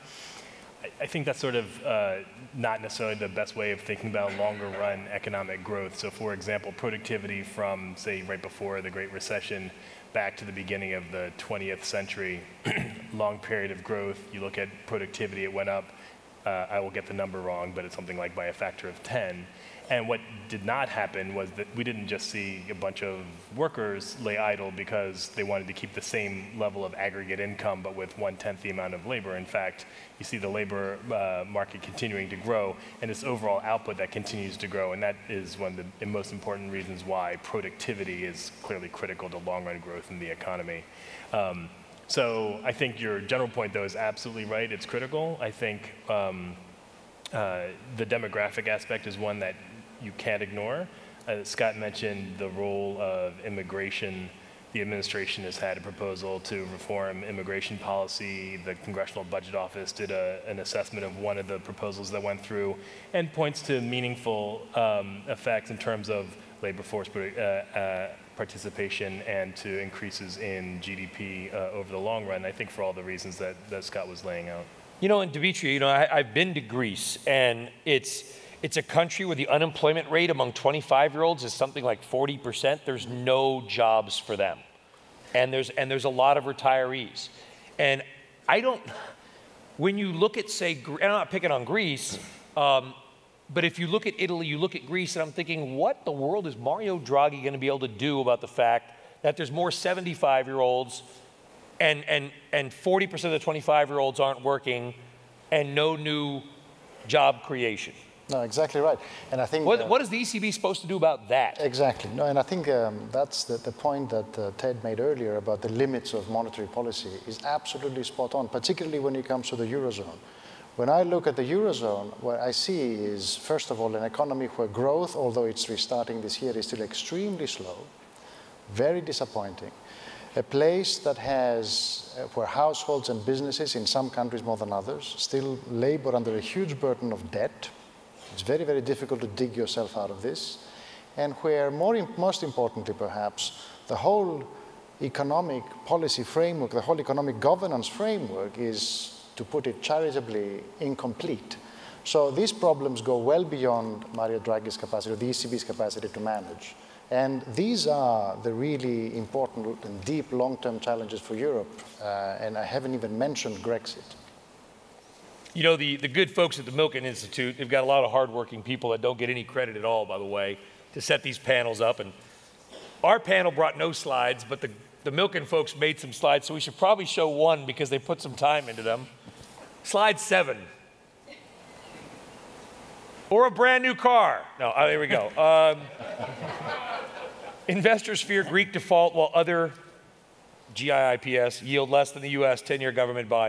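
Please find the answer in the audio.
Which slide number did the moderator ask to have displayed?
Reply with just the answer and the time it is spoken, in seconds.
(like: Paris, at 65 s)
7, at 179 s.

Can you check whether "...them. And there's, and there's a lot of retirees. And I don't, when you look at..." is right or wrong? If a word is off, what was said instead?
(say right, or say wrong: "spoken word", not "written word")
right.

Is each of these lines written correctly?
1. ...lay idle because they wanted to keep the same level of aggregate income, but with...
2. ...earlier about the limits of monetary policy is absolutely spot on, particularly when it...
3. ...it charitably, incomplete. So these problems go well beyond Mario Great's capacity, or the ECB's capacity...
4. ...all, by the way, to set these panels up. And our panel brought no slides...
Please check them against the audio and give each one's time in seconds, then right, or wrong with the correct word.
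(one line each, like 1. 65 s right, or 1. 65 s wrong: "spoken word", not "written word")
1. 24 s right
2. 114 s right
3. 149 s wrong: "Draghi", not "Great"
4. 169 s right.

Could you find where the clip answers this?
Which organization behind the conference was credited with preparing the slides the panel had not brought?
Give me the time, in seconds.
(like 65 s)
166 s.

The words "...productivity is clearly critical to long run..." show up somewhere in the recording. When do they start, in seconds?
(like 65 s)
37 s.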